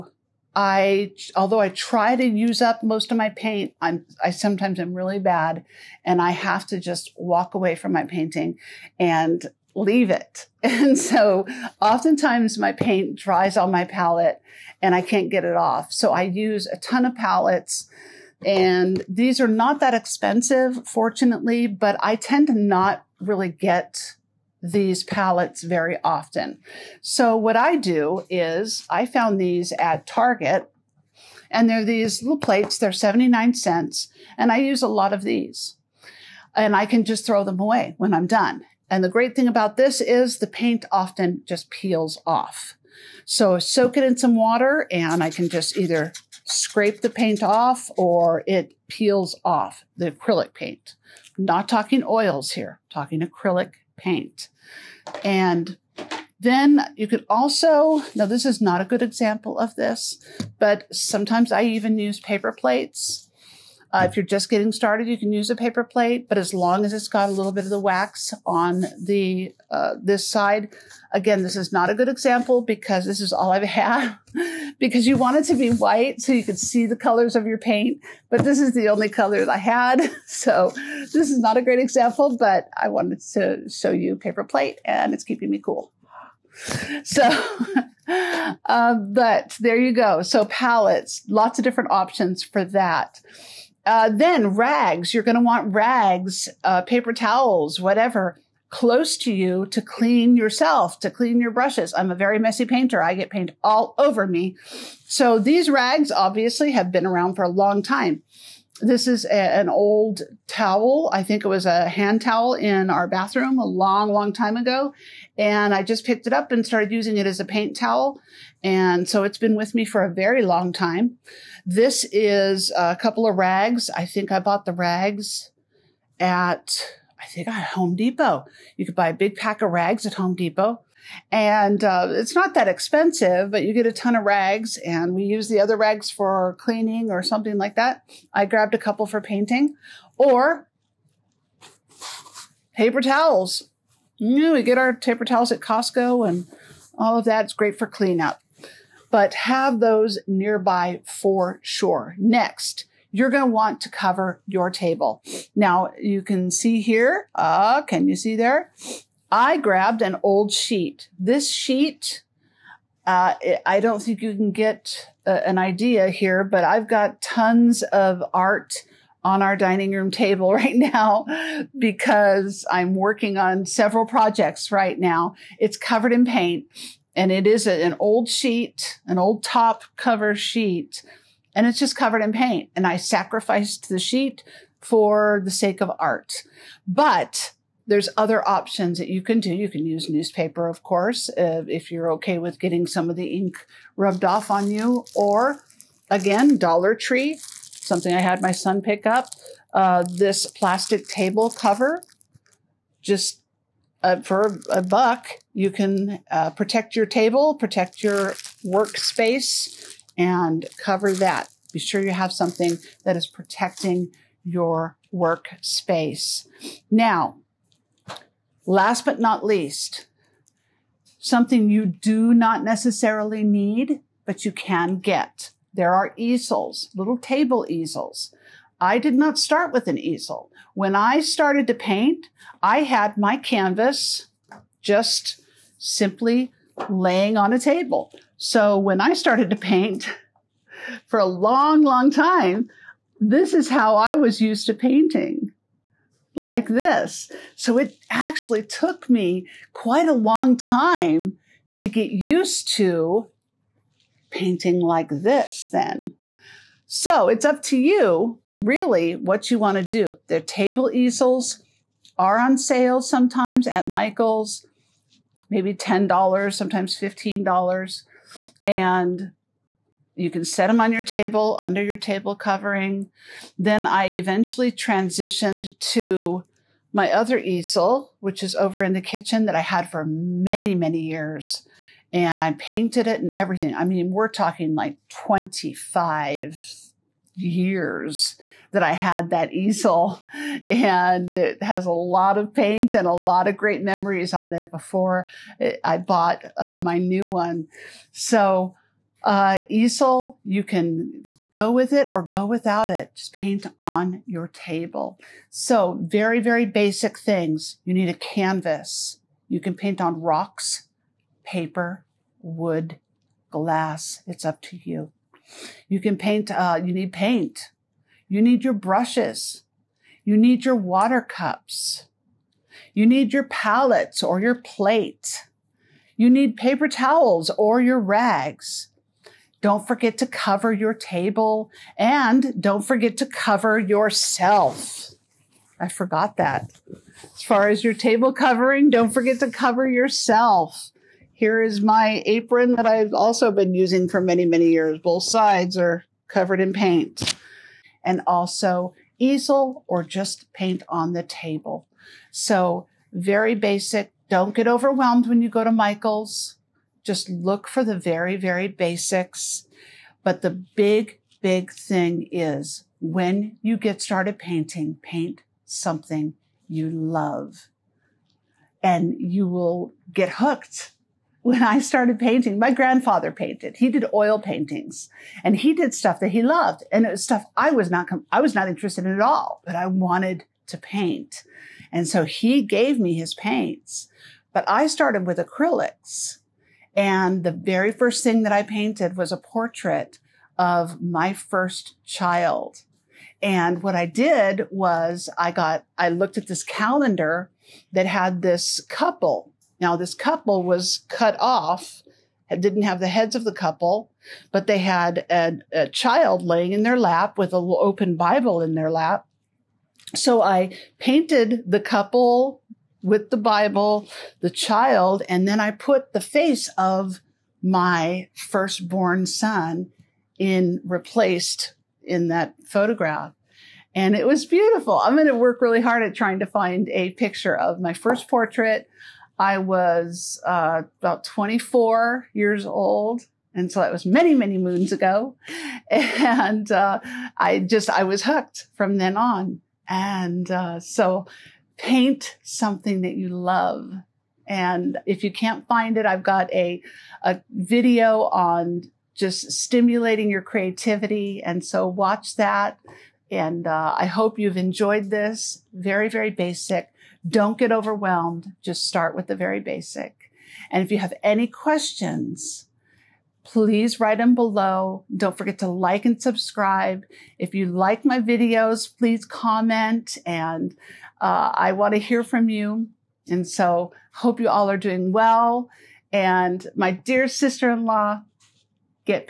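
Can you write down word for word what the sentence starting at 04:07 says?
So it actually took me quite a long time to get used to painting like this then.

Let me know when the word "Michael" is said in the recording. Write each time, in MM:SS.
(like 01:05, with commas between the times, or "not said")
04:23, 05:55.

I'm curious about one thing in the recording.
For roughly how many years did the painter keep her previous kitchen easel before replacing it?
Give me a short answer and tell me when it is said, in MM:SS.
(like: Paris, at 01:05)
25 years, at 04:45.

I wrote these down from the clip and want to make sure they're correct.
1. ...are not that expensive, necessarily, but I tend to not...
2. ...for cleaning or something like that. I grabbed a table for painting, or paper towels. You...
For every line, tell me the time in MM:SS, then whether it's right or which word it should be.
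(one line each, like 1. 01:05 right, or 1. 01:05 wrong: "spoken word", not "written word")
1. 00:19 wrong: "fortunately", not "necessarily"
2. 02:16 wrong: "couple", not "table".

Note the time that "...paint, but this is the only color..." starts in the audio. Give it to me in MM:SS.
01:17.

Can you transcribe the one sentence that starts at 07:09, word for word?
I was uh, about 24 years old.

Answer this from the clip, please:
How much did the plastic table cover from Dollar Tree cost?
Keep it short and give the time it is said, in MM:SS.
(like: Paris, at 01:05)
a buck, at 03:24.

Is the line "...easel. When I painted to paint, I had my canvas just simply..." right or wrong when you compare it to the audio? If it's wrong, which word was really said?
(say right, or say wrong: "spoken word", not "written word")
wrong: "started", not "painted".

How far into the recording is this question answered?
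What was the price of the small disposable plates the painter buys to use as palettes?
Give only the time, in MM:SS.
00:32.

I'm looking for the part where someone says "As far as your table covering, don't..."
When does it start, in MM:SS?
05:37.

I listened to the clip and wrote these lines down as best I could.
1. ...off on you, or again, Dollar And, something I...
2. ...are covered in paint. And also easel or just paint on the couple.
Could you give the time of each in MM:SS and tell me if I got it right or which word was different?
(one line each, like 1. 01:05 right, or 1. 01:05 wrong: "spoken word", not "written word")
1. 03:14 wrong: "Tree", not "And"
2. 05:45 wrong: "table", not "couple".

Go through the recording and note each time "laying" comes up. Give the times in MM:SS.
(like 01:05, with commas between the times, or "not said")
03:56, 06:46.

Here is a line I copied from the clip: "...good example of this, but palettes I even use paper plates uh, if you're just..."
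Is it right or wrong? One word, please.
wrong.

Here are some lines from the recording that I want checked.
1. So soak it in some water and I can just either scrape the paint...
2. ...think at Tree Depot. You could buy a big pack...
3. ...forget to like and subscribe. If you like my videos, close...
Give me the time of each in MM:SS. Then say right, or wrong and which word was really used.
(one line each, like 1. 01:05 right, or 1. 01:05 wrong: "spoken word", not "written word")
1. 00:43 right
2. 02:07 wrong: "Home", not "Tree"
3. 07:45 wrong: "please", not "close".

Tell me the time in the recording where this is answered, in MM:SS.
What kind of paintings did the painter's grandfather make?
06:14.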